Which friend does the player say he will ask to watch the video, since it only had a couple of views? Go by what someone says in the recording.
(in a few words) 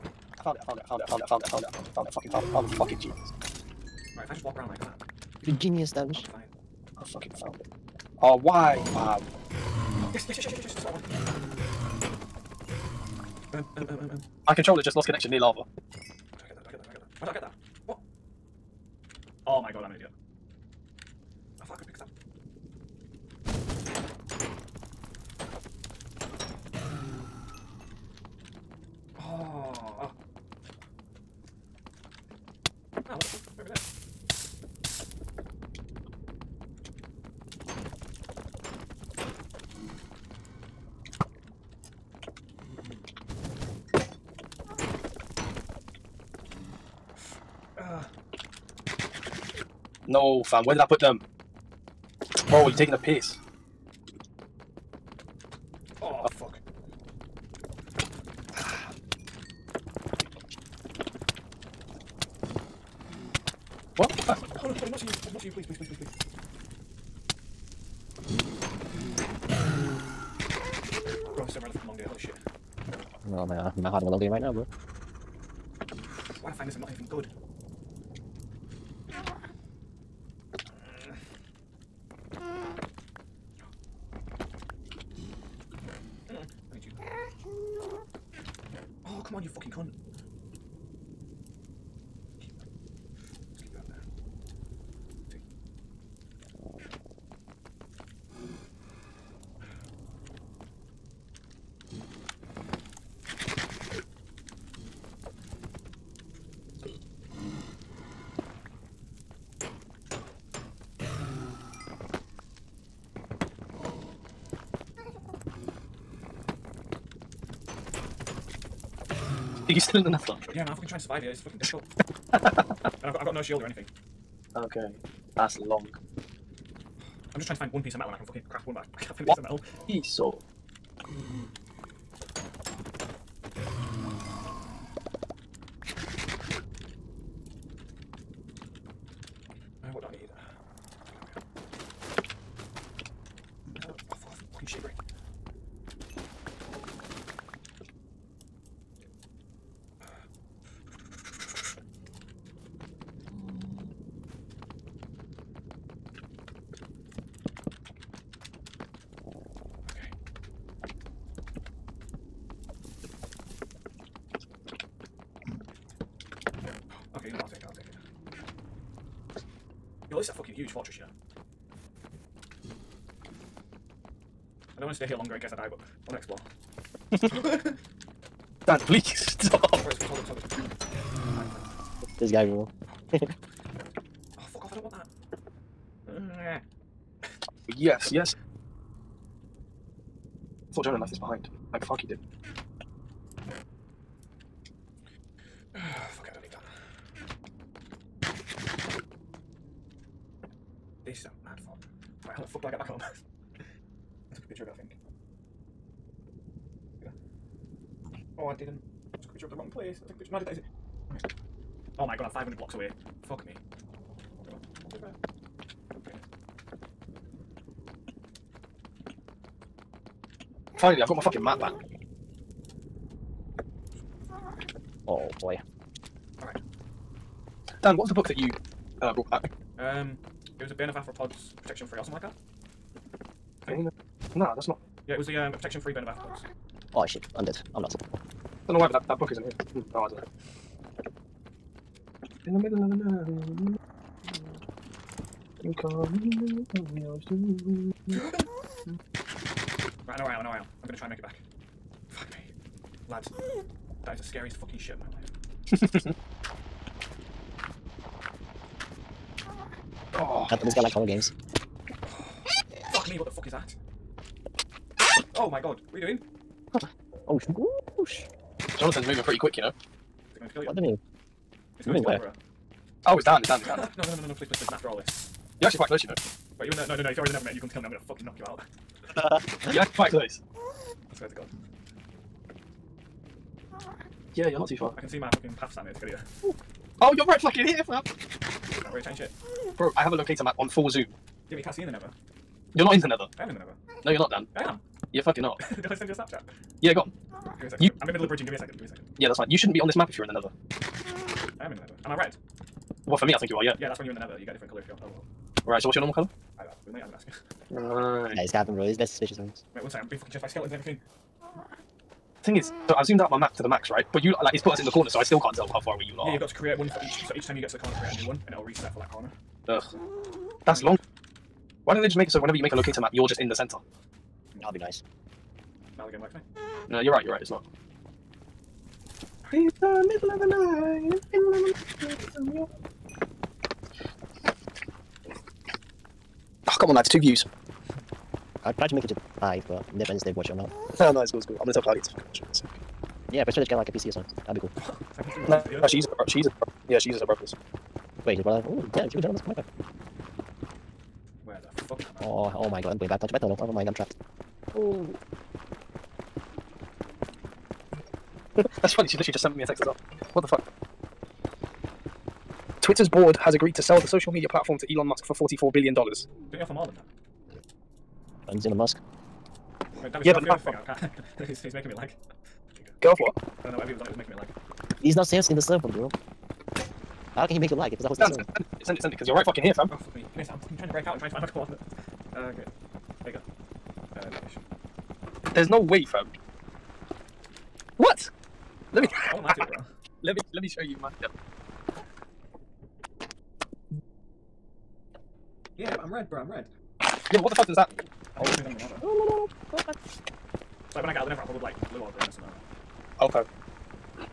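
Claudia.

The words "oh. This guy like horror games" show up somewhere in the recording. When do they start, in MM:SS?
04:20.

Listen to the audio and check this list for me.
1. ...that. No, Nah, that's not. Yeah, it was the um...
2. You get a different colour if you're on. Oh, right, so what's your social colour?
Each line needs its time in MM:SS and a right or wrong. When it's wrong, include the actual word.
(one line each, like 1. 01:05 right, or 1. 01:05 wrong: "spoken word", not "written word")
1. 03:52 right
2. 05:04 wrong: "normal", not "social".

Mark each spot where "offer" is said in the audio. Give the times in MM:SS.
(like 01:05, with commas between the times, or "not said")
06:06.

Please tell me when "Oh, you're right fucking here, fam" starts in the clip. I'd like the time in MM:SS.
04:47.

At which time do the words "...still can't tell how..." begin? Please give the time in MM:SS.
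05:15.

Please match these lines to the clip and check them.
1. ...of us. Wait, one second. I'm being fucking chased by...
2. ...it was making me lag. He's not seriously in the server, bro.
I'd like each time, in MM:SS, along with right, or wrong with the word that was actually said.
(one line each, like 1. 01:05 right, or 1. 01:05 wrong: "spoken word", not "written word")
1. 05:09 right
2. 06:14 right.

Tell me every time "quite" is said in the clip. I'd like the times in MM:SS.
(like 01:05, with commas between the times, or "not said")
04:35, 04:39.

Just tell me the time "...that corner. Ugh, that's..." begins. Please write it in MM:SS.
05:18.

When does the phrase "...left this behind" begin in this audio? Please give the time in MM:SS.
03:10.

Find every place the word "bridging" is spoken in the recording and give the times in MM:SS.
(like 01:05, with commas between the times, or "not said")
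04:58.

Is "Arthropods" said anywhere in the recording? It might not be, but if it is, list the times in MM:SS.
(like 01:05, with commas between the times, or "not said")
03:50, 03:56.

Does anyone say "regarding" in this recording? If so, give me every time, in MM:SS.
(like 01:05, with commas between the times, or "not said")
not said.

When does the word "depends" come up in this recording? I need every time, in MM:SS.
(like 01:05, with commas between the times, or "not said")
05:39, 06:08.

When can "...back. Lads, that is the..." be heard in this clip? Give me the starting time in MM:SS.
04:11.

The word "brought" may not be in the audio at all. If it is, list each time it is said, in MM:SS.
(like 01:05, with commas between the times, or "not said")
03:49.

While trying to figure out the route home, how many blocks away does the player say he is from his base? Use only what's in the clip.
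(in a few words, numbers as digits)
500.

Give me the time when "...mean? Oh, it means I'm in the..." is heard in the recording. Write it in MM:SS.
06:37.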